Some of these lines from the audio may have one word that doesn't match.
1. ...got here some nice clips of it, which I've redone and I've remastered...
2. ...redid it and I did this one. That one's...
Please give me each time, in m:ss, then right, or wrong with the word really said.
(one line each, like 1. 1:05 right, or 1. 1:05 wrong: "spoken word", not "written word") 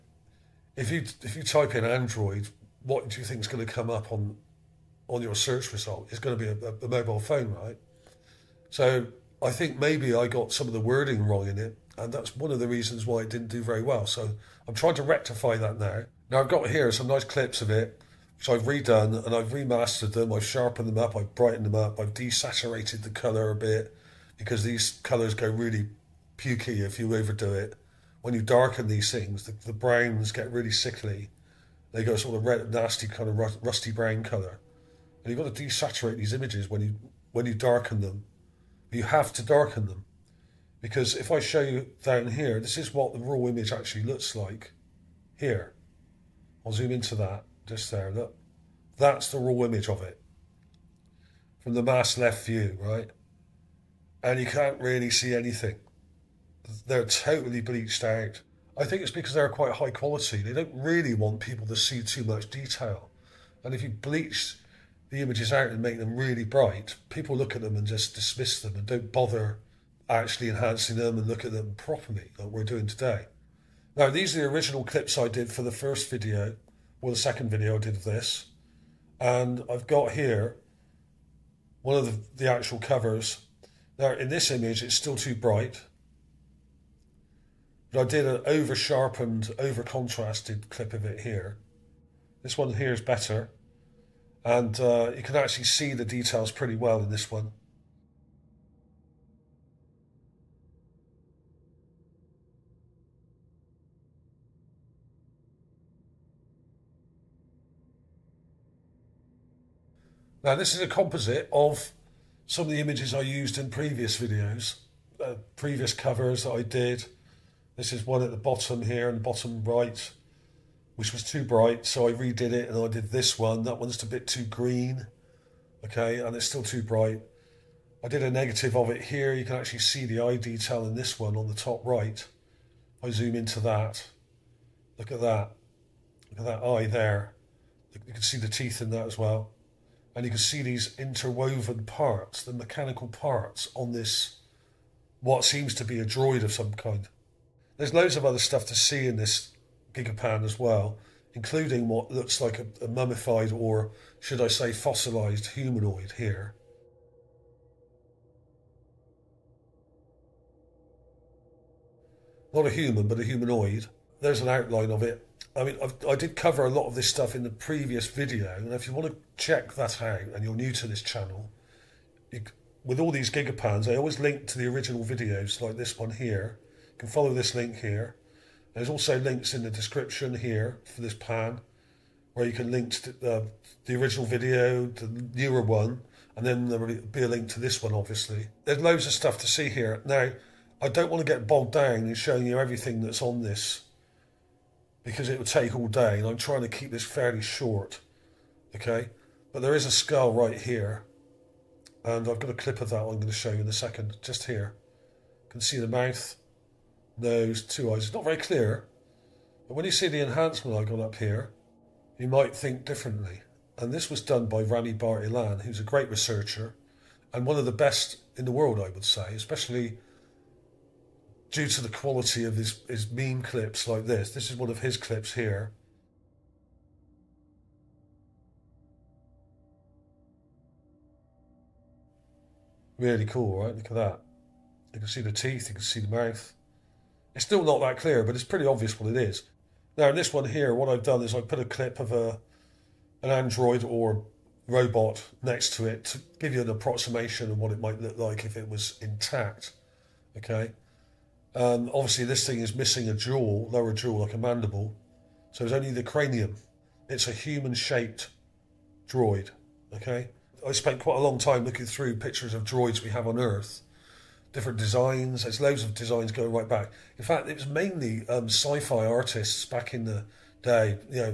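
1. 0:16 right
2. 2:02 right.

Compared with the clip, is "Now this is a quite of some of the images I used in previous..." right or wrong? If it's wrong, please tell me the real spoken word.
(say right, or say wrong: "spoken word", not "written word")
wrong: "composite", not "quite".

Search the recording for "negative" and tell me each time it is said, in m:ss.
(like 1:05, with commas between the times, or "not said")
2:08.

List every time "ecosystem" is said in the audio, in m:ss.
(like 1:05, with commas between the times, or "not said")
not said.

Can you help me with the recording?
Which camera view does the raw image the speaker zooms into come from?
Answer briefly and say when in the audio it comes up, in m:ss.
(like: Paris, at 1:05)
mass left view, at 0:51.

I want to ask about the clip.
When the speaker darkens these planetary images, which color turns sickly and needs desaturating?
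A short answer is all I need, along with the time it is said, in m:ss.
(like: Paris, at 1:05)
brown, at 0:29.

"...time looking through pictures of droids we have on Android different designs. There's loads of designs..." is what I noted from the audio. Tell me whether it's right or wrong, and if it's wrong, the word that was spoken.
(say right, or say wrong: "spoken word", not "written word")
wrong: "Earth", not "Android".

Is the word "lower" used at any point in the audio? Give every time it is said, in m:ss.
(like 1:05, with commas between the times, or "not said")
4:13.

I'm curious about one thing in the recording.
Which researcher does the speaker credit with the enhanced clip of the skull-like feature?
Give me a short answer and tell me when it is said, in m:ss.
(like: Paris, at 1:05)
Rani Bartilan, at 3:34.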